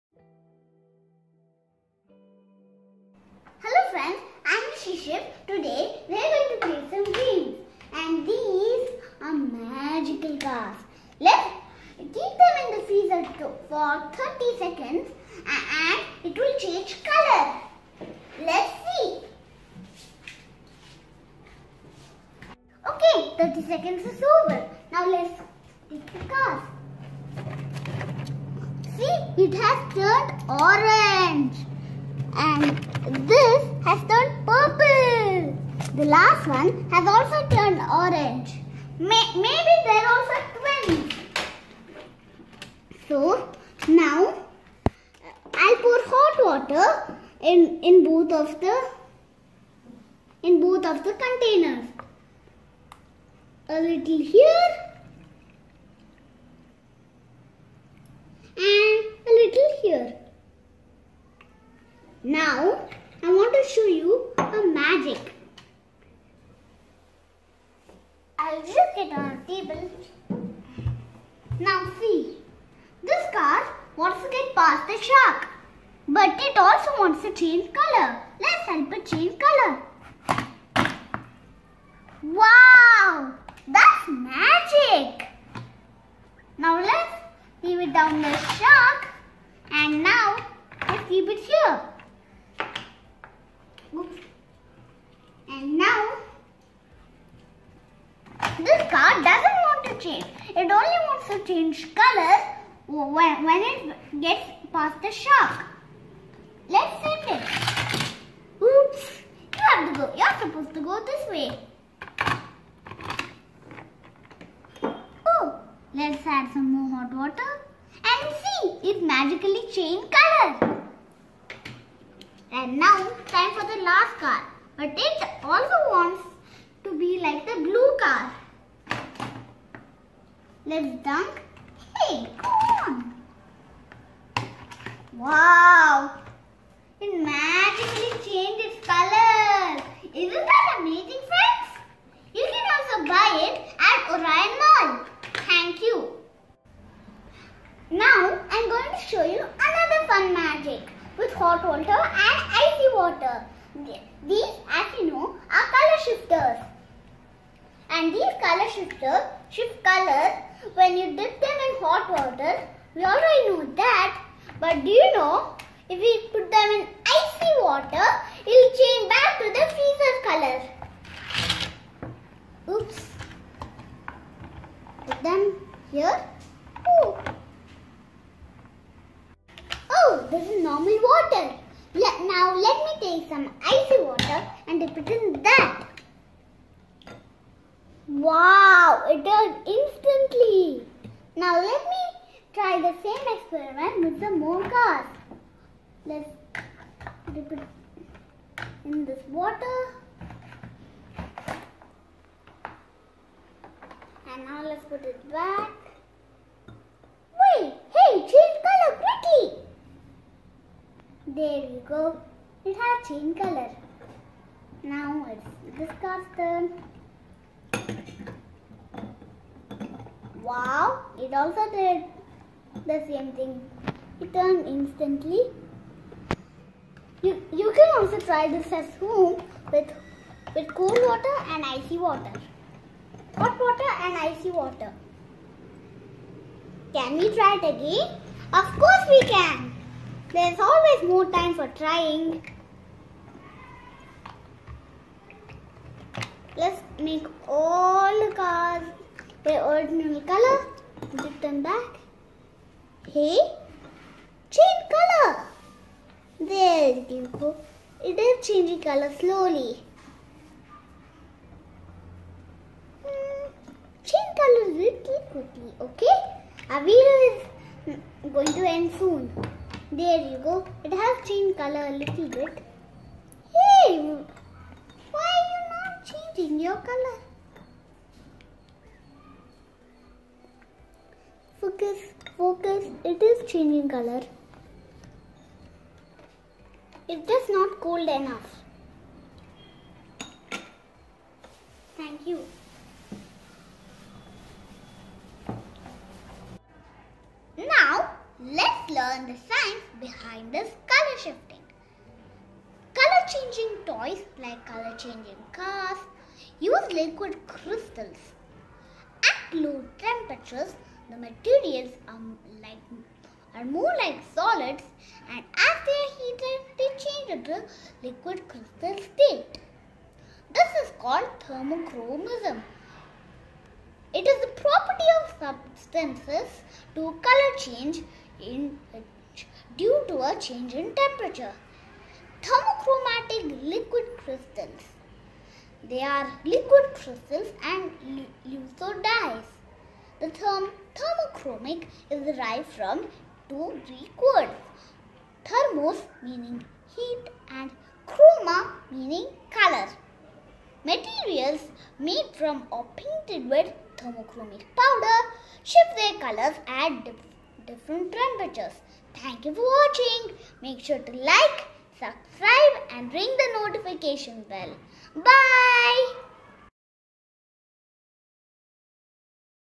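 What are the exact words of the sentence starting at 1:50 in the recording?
You're supposed to go this way.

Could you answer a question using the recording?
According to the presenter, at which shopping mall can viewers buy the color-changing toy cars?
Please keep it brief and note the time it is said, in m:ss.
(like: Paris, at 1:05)
Orion Mall, at 2:24.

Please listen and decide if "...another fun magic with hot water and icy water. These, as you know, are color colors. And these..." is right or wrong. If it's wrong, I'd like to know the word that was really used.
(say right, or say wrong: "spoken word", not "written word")
wrong: "shifters", not "colors".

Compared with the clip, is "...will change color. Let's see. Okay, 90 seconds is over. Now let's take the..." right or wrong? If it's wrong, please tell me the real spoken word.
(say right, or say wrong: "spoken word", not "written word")
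wrong: "30", not "90".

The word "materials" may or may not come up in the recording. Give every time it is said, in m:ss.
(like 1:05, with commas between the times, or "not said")
5:11, 5:50.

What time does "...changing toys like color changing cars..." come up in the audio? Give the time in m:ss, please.
5:03.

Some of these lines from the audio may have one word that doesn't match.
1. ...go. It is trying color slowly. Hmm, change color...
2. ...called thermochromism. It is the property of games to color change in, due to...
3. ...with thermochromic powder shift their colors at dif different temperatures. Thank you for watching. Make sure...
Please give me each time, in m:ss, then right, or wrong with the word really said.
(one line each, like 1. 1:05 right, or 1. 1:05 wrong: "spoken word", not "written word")
1. 4:17 wrong: "changing", not "trying"
2. 5:20 wrong: "substances", not "games"
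3. 5:53 right.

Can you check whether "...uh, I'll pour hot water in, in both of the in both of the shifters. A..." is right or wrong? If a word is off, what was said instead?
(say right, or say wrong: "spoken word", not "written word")
wrong: "containers", not "shifters".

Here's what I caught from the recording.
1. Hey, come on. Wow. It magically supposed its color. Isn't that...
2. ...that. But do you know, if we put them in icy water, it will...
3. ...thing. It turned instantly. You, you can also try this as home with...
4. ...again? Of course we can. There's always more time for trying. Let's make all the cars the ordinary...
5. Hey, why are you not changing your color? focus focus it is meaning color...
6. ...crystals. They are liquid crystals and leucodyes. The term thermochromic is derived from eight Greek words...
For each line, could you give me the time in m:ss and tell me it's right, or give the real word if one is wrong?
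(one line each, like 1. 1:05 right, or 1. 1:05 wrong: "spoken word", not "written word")
1. 2:11 wrong: "changed", not "supposed"
2. 2:43 right
3. 3:43 right
4. 3:57 right
5. 4:33 wrong: "changing", not "meaning"
6. 5:34 wrong: "two", not "eight".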